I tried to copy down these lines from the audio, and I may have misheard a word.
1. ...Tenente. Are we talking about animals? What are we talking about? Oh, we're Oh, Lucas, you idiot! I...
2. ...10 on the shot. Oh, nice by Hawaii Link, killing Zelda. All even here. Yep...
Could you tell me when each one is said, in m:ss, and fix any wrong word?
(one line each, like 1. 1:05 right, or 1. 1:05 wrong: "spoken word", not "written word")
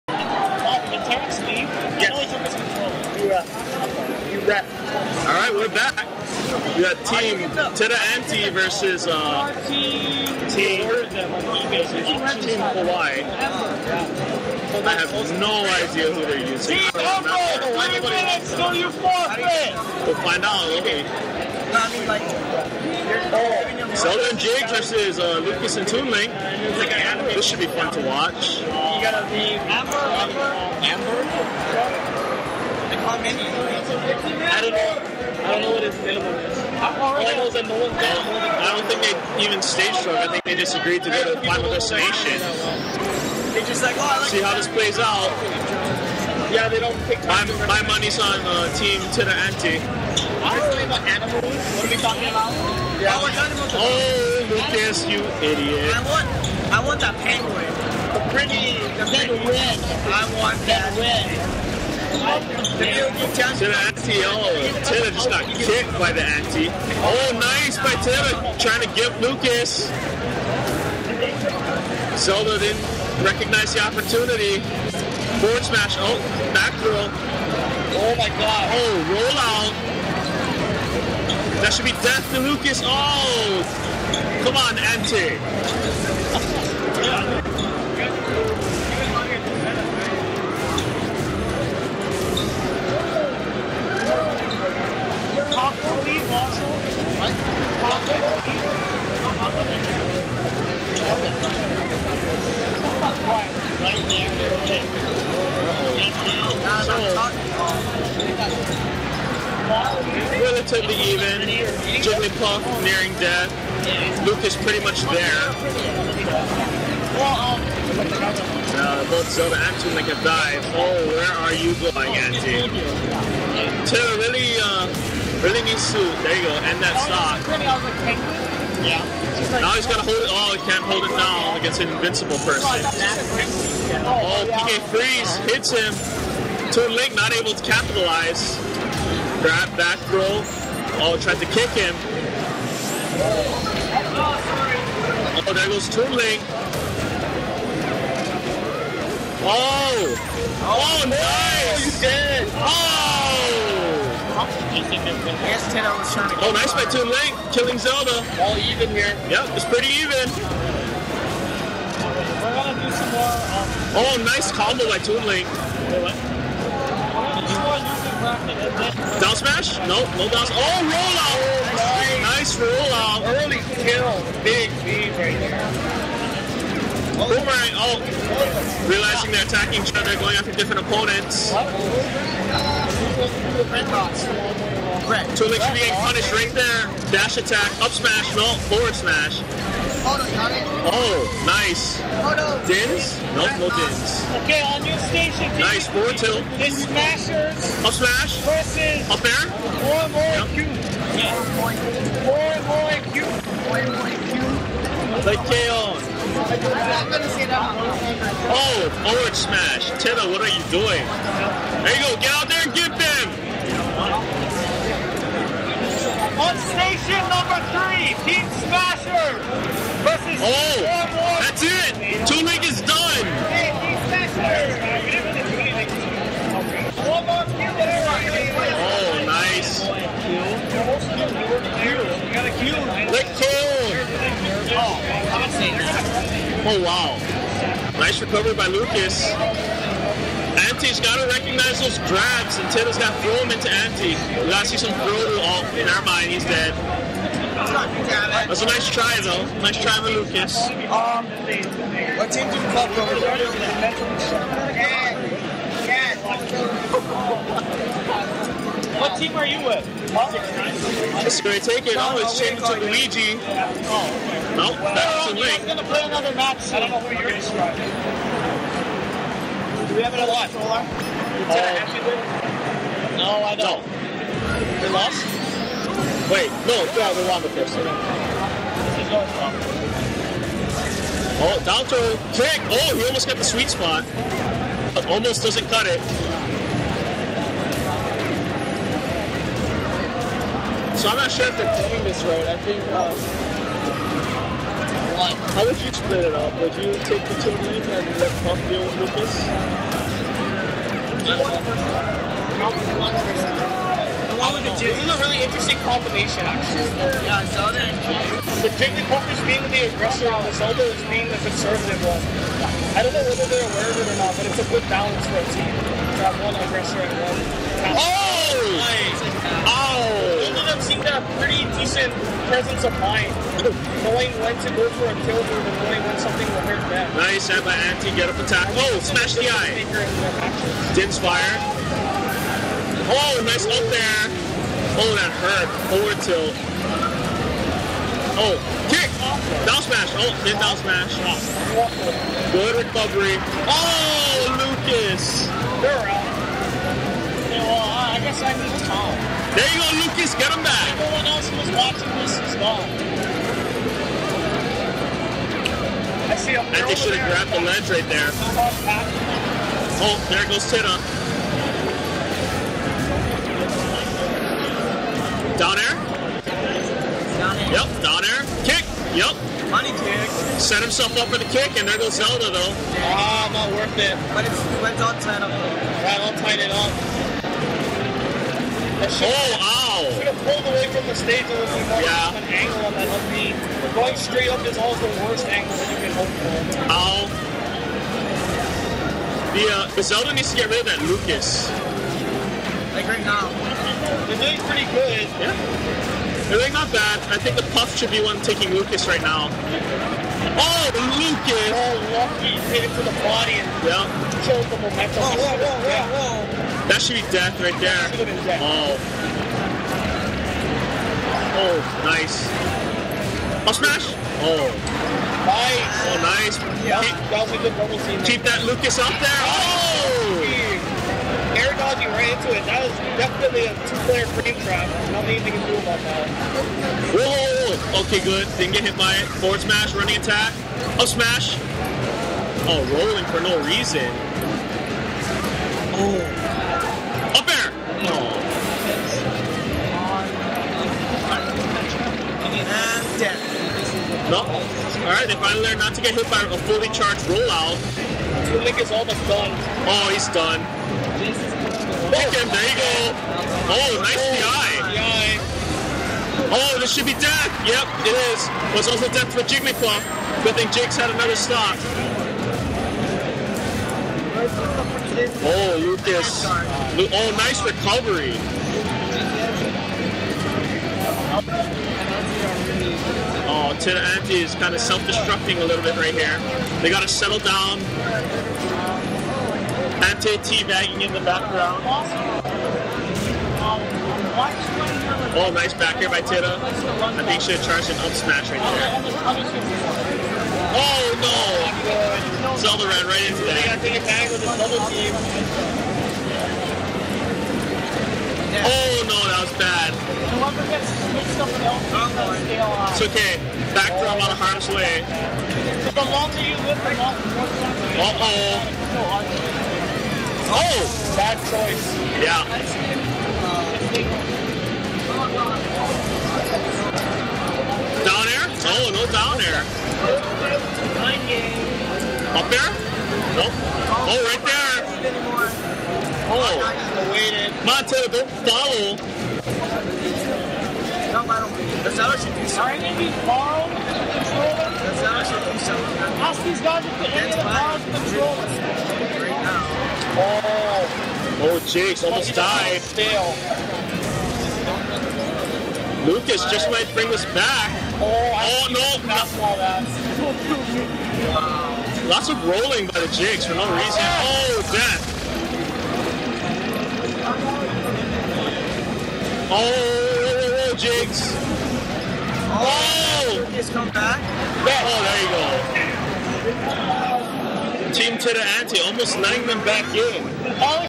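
1. 0:49 right
2. 2:35 wrong: "Toon", not "Hawaii".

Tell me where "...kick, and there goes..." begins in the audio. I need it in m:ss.
6:11.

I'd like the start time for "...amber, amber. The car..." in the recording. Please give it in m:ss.
0:30.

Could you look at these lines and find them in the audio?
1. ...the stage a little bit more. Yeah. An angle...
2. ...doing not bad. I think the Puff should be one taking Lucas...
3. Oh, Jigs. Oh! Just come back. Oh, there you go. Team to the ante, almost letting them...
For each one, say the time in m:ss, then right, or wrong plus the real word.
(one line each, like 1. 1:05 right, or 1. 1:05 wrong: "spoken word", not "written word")
1. 6:21 right
2. 6:36 right
3. 9:19 right.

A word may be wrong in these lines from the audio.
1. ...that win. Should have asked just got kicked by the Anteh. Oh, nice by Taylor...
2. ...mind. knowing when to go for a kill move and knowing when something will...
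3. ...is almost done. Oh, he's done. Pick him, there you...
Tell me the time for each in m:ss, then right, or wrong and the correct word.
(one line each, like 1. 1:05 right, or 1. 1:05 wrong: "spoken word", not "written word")
1. 1:00 right
2. 5:22 right
3. 7:28 right.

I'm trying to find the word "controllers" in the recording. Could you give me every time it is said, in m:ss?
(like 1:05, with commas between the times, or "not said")
8:53, 8:57.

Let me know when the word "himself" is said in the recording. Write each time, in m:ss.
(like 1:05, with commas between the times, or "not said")
6:10.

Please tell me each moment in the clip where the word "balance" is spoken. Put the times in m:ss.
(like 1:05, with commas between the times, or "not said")
5:14.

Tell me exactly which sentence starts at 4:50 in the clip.
So I'm not sure if they're playing this road.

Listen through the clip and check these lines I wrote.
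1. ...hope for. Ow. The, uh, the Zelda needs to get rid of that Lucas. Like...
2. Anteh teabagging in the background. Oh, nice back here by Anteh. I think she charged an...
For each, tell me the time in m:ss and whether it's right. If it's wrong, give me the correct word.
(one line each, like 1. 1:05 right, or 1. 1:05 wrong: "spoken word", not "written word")
1. 6:26 right
2. 8:00 wrong: "Tita", not "Anteh".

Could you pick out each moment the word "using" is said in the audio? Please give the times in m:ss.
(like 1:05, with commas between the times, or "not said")
0:16.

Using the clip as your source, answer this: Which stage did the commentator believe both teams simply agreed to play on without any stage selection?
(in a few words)
Final Destination.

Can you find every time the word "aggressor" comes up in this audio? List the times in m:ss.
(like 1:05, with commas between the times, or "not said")
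5:09, 5:16.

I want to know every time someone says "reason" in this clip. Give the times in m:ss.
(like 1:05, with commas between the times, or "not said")
7:13, 9:13.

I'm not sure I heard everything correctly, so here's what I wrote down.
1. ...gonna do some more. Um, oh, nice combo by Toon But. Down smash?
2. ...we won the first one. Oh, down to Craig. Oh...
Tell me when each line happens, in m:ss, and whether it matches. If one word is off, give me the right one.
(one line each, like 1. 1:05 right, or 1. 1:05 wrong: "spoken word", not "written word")
1. 2:42 wrong: "Link", not "But"
2. 4:37 right.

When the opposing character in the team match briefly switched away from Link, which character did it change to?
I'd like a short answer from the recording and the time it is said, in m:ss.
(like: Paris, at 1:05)
Luigi, at 4:22.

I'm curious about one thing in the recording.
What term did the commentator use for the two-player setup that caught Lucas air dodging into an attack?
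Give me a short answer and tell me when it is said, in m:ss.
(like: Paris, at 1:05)
Two-player frame trap, at 7:03.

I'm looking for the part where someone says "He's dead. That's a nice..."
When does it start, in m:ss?
4:06.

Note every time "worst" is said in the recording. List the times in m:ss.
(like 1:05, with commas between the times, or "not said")
6:25.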